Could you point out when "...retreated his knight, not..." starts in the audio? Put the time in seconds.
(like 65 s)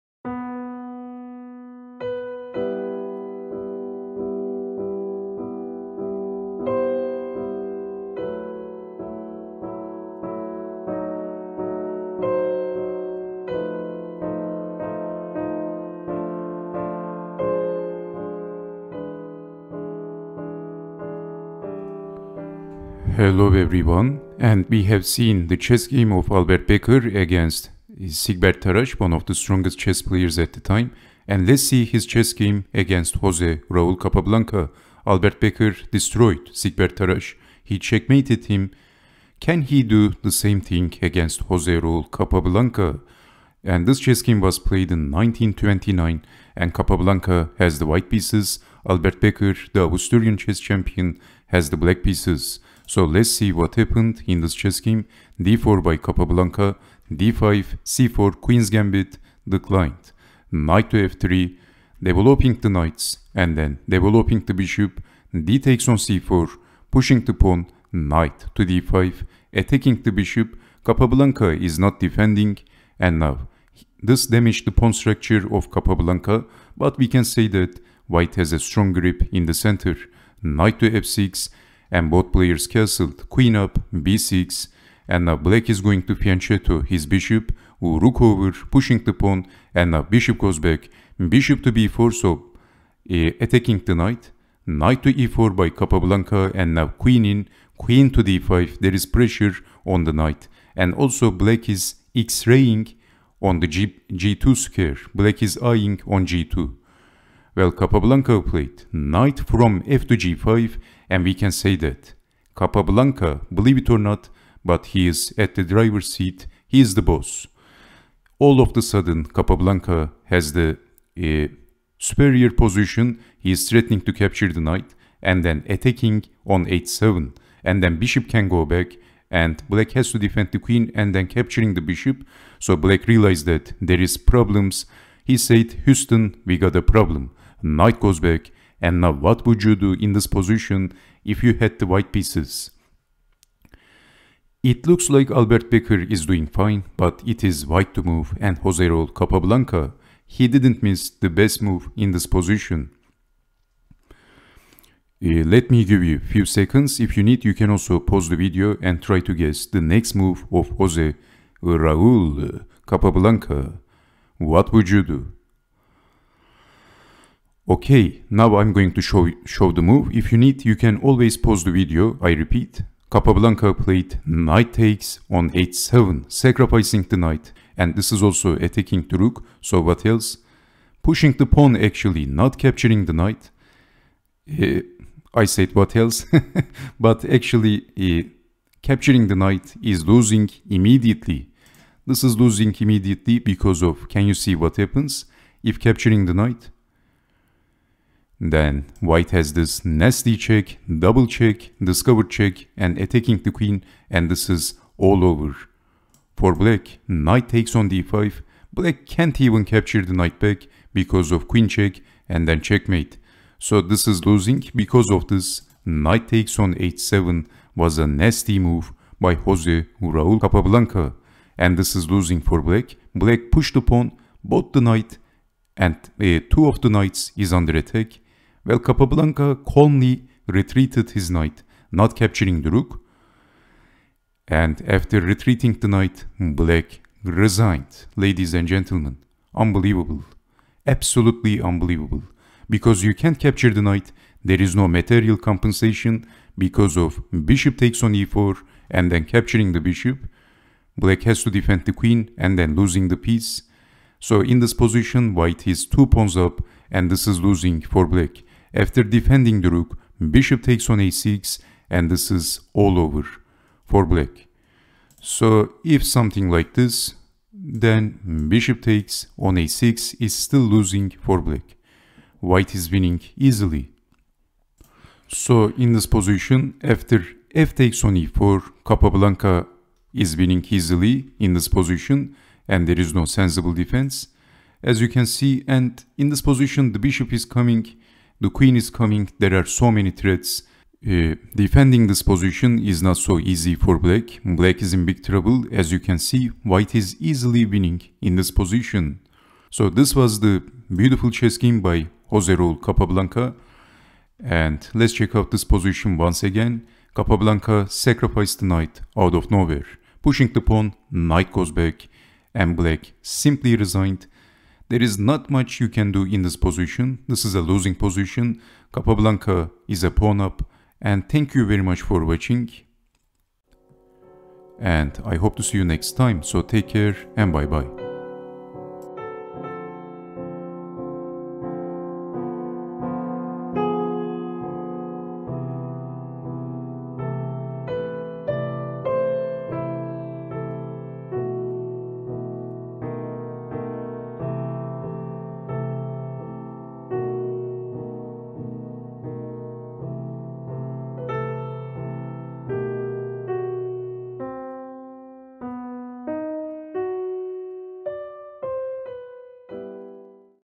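230 s.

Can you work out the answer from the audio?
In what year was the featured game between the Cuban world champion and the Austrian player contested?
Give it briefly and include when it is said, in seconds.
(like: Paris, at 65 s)
1929, at 45 s.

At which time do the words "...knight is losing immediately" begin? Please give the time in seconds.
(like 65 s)
189 s.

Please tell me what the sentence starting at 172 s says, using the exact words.
I repeat, Capablanca played knight takes on h7, sacrificing the knight.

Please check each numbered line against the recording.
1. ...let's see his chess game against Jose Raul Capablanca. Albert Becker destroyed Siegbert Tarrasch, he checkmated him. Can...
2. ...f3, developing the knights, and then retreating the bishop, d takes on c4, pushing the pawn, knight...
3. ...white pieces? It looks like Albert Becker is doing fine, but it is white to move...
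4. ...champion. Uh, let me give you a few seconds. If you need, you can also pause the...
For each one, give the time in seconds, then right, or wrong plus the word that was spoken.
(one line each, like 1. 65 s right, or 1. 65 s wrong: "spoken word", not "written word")
1. 31 s right
2. 61 s wrong: "developing", not "retreating"
3. 141 s right
4. 152 s wrong: "position", not "champion".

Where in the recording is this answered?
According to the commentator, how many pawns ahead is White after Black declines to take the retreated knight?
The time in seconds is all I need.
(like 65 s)
255 s.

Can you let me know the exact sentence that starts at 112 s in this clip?
Capablanca, believe it or not, but he is at the driver's seat, he is the boss.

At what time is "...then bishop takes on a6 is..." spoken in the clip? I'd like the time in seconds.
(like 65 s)
267 s.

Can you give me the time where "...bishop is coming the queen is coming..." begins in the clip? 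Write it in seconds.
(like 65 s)
286 s.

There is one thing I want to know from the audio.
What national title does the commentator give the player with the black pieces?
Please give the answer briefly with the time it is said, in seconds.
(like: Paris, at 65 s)
Austrian chess champion, at 49 s.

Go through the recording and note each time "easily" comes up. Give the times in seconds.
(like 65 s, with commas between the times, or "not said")
273 s, 280 s, 297 s.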